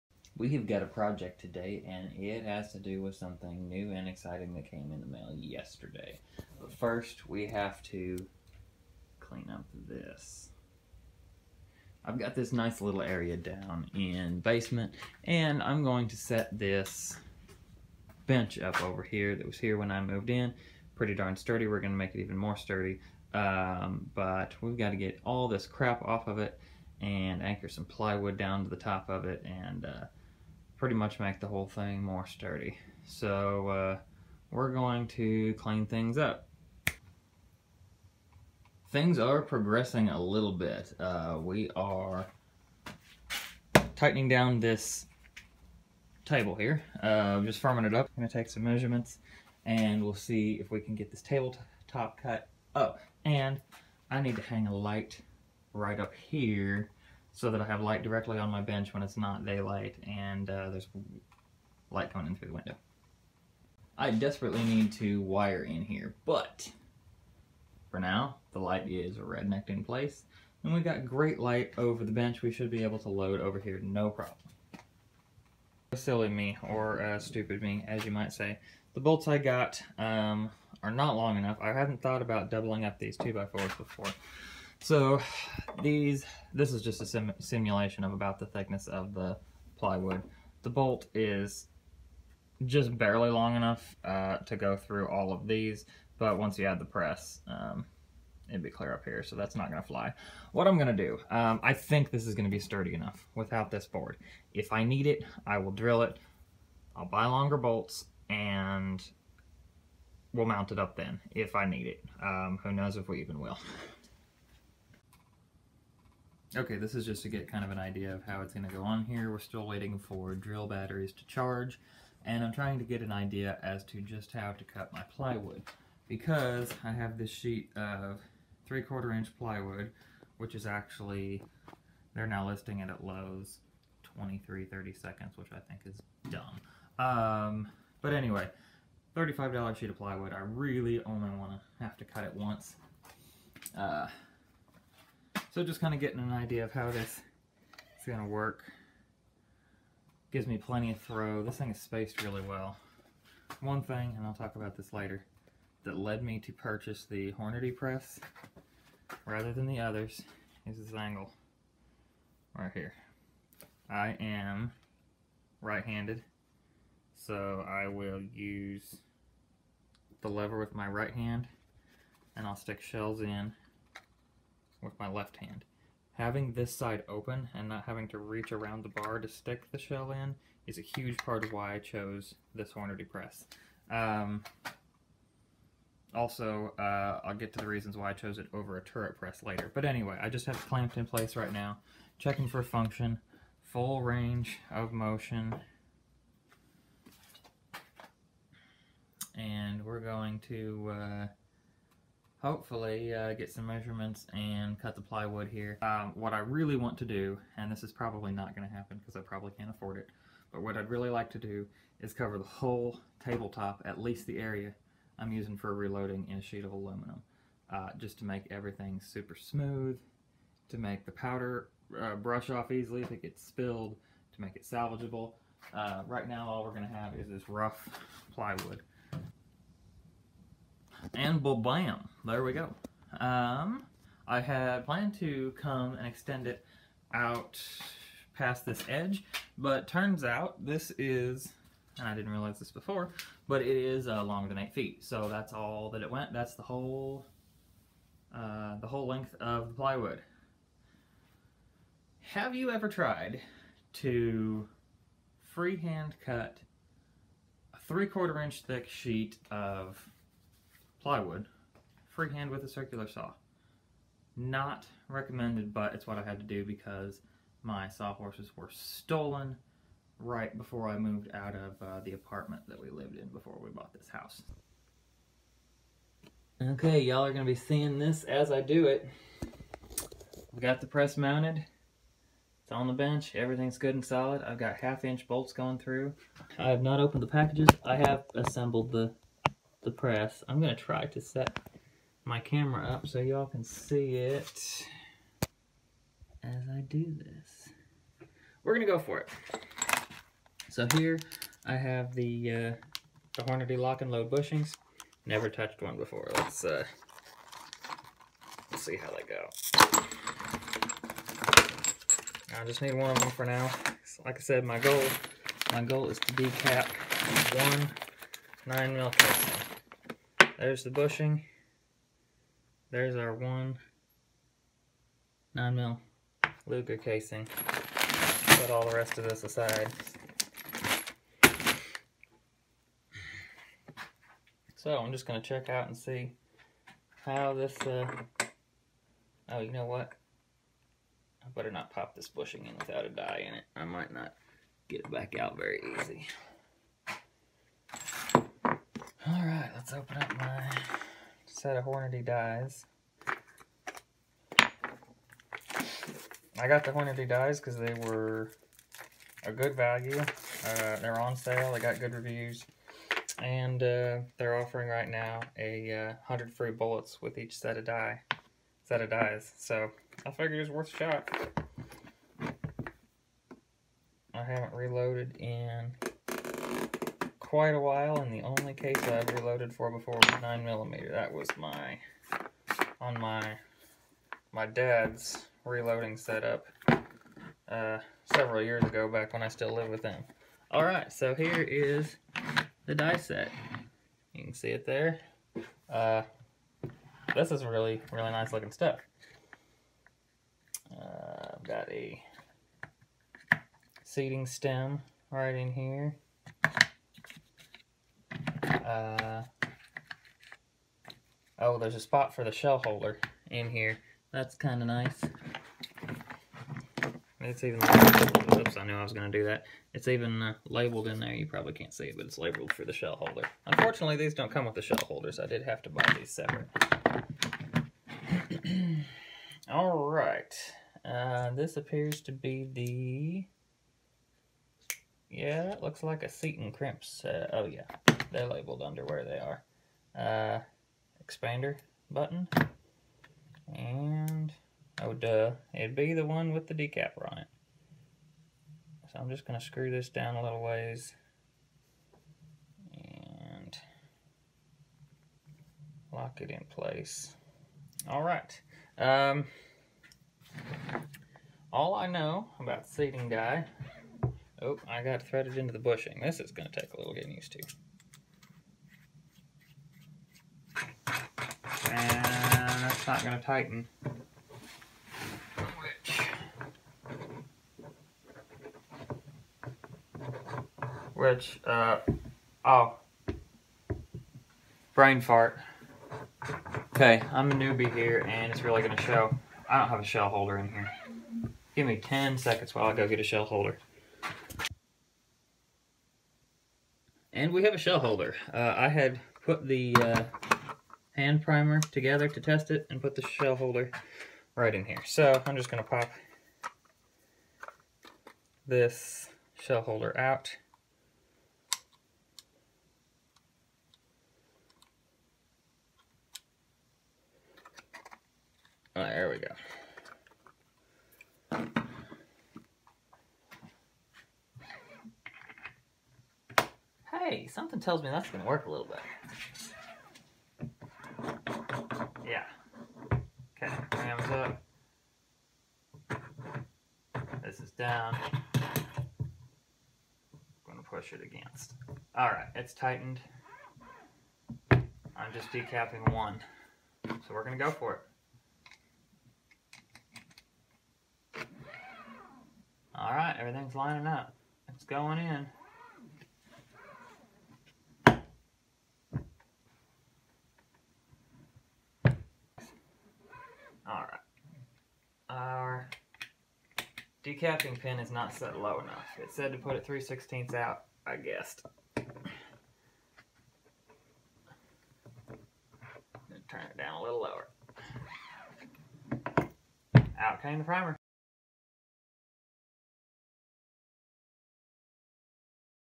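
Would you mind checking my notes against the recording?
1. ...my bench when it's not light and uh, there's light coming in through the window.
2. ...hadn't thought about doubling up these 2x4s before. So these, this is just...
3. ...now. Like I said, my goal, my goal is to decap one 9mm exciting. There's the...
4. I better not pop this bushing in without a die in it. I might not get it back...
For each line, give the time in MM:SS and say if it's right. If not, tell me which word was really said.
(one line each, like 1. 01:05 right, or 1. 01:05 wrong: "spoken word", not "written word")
1. 00:58 wrong: "daylight", not "light"
2. 01:21 right
3. 05:13 wrong: "casing", not "exciting"
4. 05:41 right.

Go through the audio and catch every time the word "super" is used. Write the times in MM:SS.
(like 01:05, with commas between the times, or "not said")
03:39.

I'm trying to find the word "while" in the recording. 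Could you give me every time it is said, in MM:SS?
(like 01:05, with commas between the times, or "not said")
06:17, 08:12.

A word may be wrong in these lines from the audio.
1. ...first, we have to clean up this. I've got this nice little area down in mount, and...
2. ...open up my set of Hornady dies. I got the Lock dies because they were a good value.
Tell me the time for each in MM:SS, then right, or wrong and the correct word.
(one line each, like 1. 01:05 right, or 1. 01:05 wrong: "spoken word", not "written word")
1. 00:06 wrong: "basement", not "mount"
2. 05:49 wrong: "Hornady", not "Lock".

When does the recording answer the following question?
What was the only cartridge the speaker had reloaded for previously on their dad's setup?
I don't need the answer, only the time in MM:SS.
06:20.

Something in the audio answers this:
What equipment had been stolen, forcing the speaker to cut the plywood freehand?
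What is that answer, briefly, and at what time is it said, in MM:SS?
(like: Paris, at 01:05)
Sawhorses, at 04:27.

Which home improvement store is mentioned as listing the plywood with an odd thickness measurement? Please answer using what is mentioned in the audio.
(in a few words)
Lowe's.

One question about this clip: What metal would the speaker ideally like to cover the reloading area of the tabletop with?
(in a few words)
Aluminum.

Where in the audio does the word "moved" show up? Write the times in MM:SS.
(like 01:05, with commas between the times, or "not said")
00:20, 04:30.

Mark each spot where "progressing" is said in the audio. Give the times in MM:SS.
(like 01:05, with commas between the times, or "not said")
00:39.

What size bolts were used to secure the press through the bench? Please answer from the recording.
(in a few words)
Half-inch.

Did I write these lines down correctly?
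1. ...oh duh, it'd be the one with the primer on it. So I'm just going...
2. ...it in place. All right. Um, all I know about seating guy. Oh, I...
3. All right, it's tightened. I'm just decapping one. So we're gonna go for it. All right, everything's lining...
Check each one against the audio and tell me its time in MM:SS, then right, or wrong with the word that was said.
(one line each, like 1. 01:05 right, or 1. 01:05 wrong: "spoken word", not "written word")
1. 07:25 wrong: "decapper", not "primer"
2. 07:36 right
3. 09:02 right.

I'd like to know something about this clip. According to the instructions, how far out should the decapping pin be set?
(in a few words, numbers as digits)
3/16.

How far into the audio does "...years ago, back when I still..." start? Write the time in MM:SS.
06:28.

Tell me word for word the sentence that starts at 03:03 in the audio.
Um, also, uh, I'll get to the reasons why I chose it over a turret press later.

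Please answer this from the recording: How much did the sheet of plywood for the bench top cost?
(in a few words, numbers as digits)
$35.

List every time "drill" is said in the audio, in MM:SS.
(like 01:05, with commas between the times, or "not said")
01:45, 02:00.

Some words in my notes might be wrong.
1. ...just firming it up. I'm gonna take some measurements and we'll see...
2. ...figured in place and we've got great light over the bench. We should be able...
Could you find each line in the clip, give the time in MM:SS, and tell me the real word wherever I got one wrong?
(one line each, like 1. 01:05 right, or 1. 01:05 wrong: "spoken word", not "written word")
1. 00:47 right
2. 01:09 wrong: "rednecked", not "figured".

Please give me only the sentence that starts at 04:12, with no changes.
Have you ever tried to freehand cut a three-quarter inch thick sheet of plywood, freehand with a circular saw.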